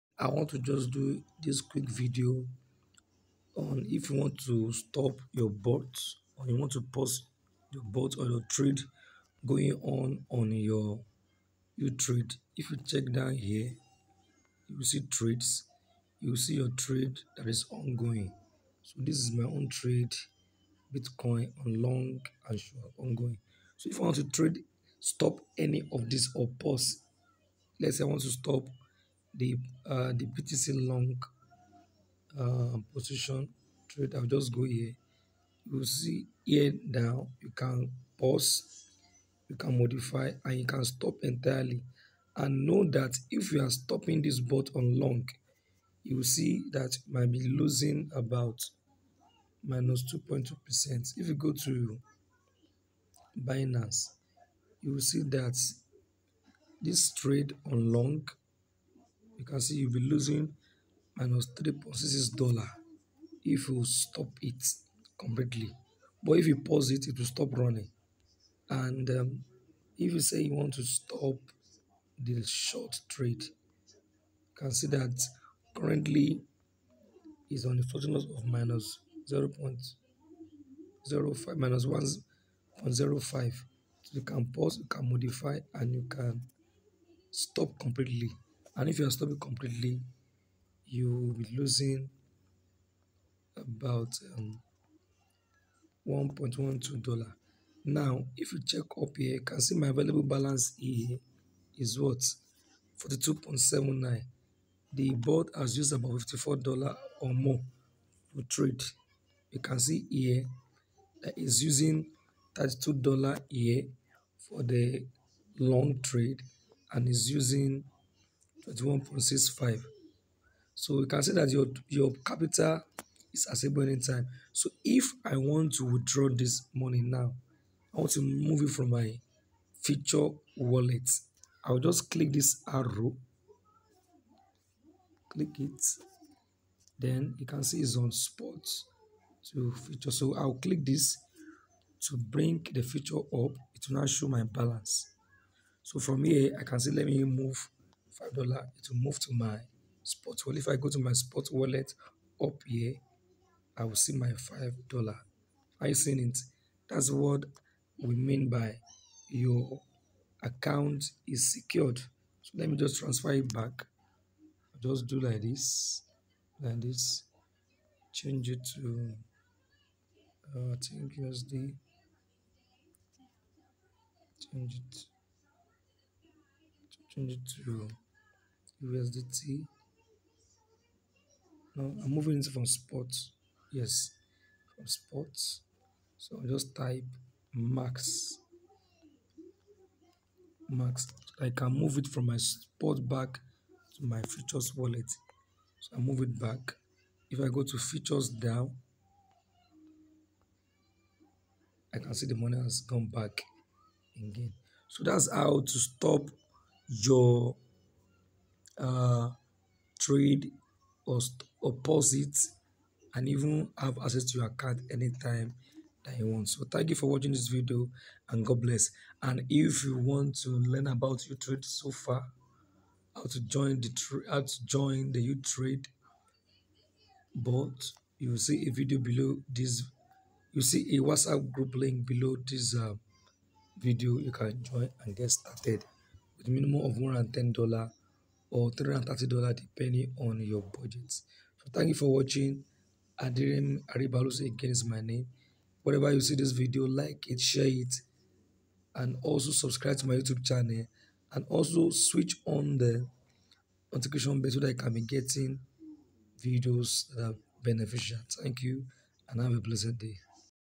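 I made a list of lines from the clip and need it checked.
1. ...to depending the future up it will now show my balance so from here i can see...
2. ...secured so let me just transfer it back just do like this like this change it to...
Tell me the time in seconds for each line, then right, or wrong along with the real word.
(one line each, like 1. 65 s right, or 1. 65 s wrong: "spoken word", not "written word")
1. 141 s wrong: "bring", not "depending"
2. 161 s right.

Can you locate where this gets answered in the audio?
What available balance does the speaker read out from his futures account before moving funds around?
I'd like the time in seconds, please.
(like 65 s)
102 s.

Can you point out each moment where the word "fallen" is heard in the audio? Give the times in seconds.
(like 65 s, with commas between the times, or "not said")
not said.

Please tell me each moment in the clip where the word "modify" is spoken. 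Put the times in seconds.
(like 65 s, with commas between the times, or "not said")
39 s, 85 s.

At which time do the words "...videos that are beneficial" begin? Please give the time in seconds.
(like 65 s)
256 s.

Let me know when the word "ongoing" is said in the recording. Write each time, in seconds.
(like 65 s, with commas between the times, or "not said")
17 s, 22 s.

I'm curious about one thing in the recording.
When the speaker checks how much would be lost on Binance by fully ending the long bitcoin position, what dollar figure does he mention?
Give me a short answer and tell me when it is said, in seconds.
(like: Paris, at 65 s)
3.66 dollars, at 61 s.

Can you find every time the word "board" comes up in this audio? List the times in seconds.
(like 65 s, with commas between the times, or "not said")
105 s.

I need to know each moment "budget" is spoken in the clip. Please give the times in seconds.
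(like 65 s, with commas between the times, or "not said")
240 s.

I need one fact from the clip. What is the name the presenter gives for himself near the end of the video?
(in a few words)
Aderemi Aribalusi.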